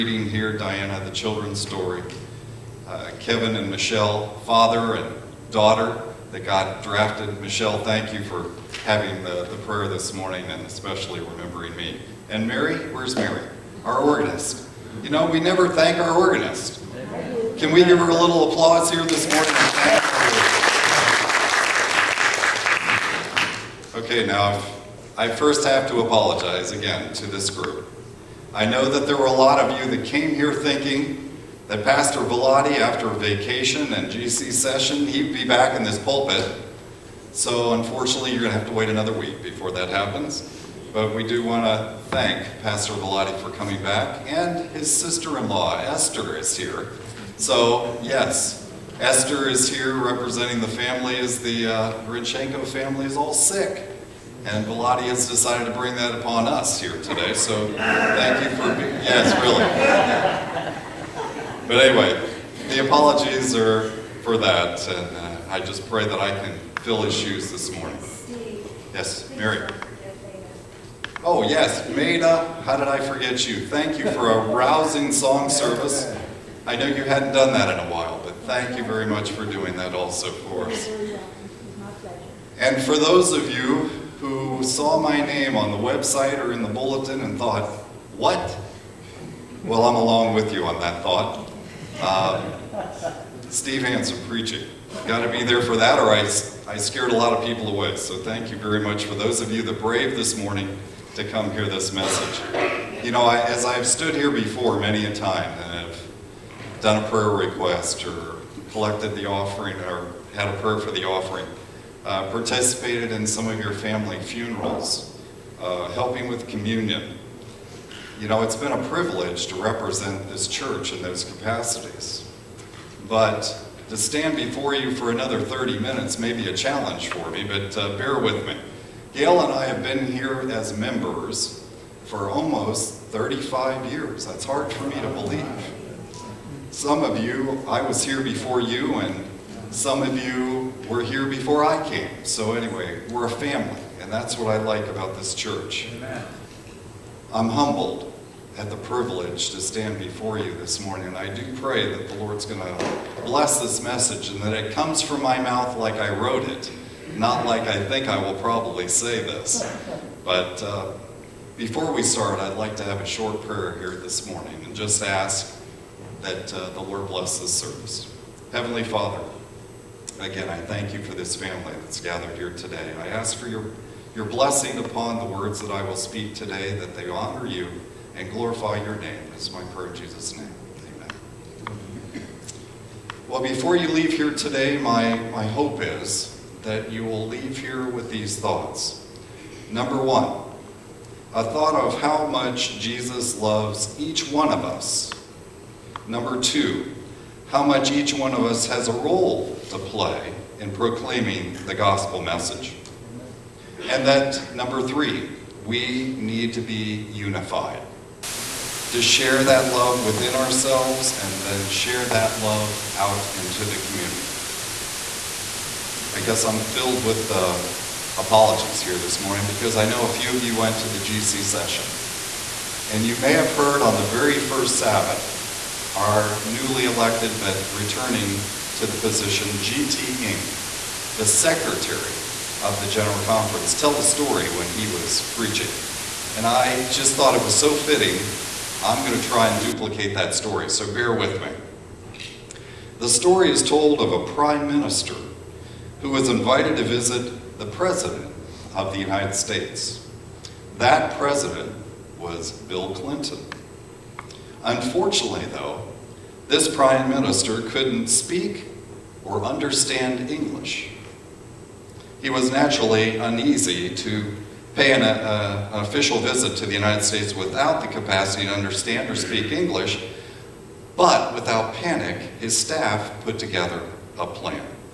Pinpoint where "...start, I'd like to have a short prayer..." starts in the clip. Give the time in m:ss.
2:42.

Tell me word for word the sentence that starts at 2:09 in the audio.
Gail and I have been here as members for almost 35 years.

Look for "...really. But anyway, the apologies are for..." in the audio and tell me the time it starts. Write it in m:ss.
0:59.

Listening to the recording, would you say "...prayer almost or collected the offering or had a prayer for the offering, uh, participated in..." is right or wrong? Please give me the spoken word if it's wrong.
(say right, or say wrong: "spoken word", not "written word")
wrong: "request", not "almost".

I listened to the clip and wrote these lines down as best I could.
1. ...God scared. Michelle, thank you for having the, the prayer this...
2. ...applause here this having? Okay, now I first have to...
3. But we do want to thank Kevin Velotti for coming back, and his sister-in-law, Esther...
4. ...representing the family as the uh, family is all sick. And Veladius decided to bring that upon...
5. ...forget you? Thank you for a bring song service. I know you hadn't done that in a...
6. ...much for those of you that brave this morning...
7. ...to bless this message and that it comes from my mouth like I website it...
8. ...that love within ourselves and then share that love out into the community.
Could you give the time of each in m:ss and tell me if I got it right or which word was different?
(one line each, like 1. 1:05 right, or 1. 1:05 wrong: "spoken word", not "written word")
1. 0:06 wrong: "drafted", not "scared"
2. 0:18 wrong: "morning", not "having"
3. 0:40 wrong: "Pastor", not "Kevin"
4. 0:49 right
5. 1:12 wrong: "rousing", not "bring"
6. 1:38 right
7. 2:32 wrong: "wrote", not "website"
8. 3:29 right.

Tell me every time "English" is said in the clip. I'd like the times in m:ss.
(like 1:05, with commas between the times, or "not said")
4:20, 4:29.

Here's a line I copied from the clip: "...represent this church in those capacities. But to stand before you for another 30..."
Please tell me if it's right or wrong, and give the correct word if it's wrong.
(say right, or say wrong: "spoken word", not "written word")
right.